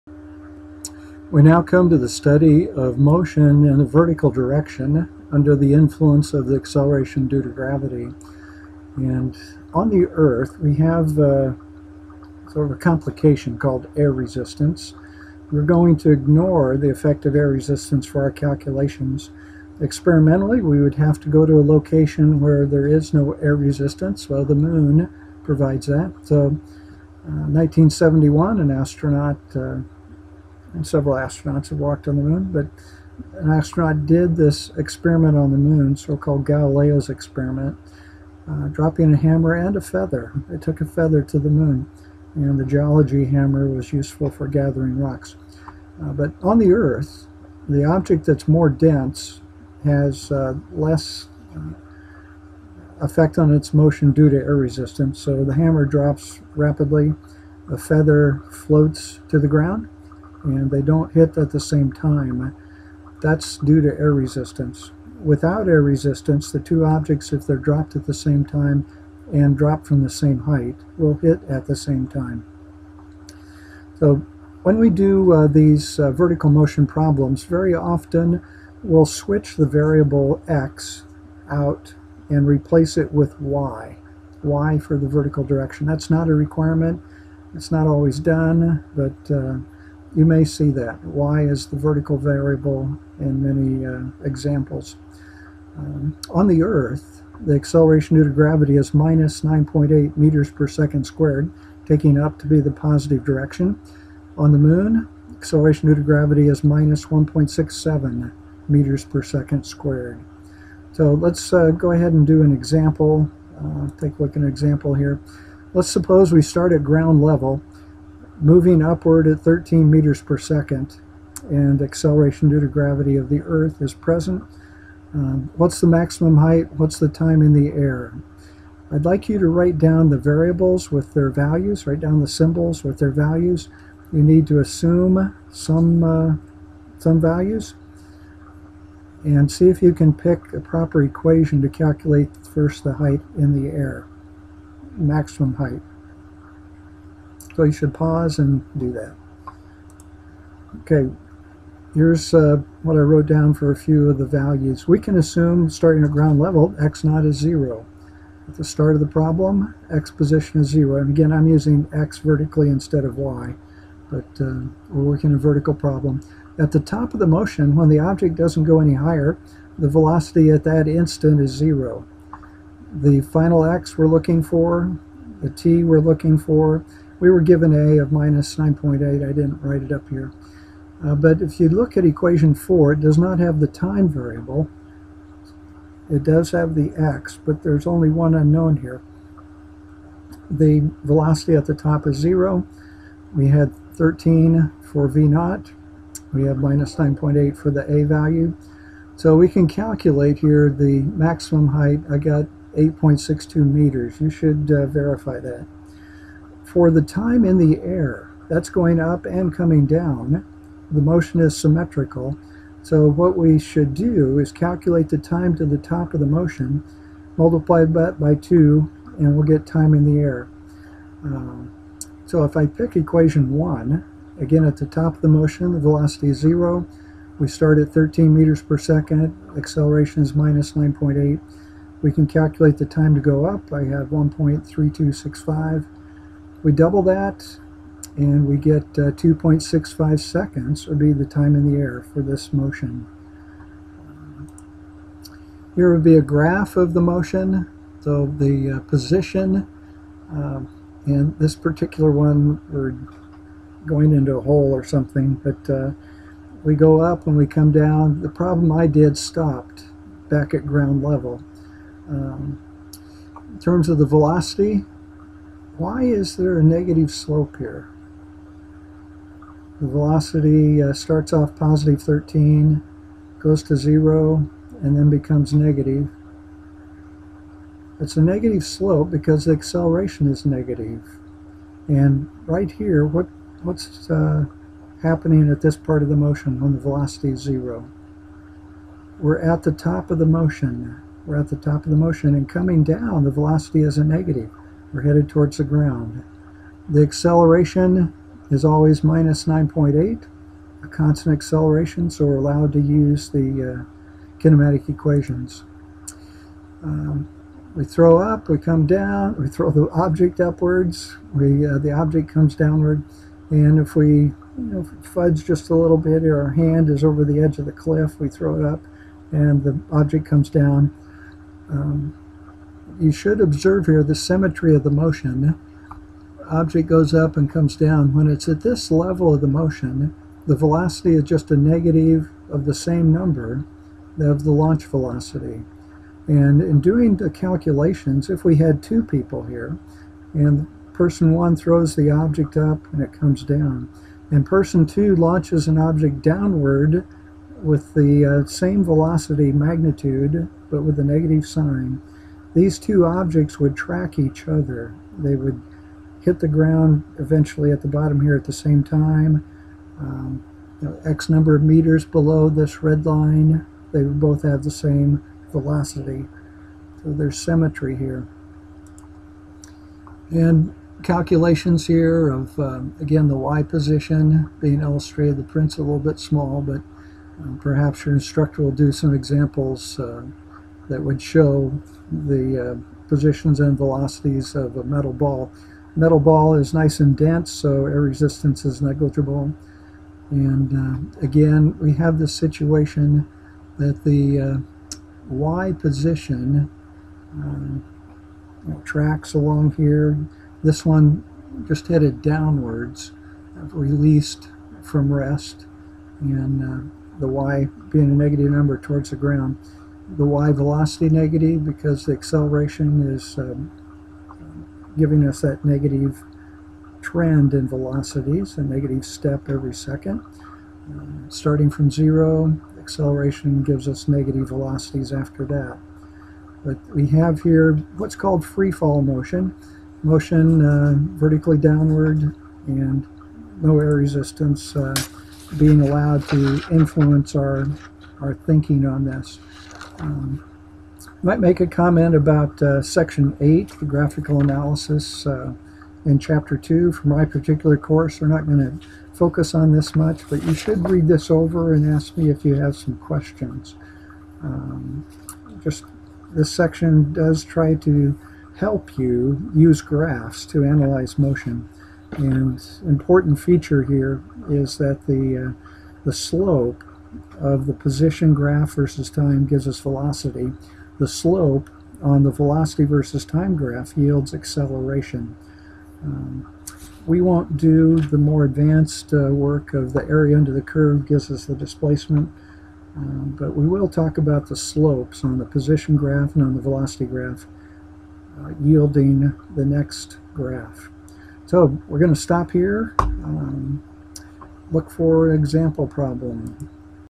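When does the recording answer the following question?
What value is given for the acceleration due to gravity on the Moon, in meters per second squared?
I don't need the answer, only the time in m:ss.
1:46.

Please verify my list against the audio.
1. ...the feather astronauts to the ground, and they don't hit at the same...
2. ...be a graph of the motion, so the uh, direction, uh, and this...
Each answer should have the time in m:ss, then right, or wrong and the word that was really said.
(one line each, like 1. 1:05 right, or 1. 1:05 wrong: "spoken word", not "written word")
1. 0:57 wrong: "floats", not "astronauts"
2. 4:06 wrong: "position", not "direction".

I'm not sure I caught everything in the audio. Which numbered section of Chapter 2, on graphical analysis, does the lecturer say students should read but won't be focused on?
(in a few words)
Section 8.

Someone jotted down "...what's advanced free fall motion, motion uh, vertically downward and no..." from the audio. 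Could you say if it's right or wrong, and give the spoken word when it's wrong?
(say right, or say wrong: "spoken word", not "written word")
wrong: "called", not "advanced".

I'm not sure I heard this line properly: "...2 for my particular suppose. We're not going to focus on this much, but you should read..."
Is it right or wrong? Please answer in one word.
wrong.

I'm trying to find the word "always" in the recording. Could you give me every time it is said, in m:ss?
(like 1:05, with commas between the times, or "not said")
1:27, 4:58.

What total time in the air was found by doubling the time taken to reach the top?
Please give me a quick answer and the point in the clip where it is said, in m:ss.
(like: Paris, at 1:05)
2.65 seconds, at 3:59.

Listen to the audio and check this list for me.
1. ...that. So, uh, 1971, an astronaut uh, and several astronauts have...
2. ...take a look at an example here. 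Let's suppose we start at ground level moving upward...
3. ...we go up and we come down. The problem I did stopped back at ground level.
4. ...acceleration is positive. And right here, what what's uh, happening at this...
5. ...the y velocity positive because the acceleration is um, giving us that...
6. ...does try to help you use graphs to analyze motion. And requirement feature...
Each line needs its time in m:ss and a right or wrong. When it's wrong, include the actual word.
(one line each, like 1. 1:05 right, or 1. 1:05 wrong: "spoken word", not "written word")
1. 0:25 right
2. 1:53 right
3. 4:16 right
4. 4:39 wrong: "negative", not "positive"
5. 6:50 wrong: "negative", not "positive"
6. 7:37 wrong: "important", not "requirement".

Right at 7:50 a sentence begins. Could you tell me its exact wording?
The slope on the velocity versus time graph yields acceleration.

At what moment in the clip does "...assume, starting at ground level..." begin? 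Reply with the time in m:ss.
2:35.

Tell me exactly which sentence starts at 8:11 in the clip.
So we're going to stop here.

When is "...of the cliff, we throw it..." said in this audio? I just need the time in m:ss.
5:17.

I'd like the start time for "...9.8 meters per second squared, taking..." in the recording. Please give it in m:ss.
1:39.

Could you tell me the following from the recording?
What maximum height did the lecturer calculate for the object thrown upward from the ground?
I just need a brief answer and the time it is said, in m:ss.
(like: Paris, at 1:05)
8.62 meters, at 3:22.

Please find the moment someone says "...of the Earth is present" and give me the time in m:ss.
2:03.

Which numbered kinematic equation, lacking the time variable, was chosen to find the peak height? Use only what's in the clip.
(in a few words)
4.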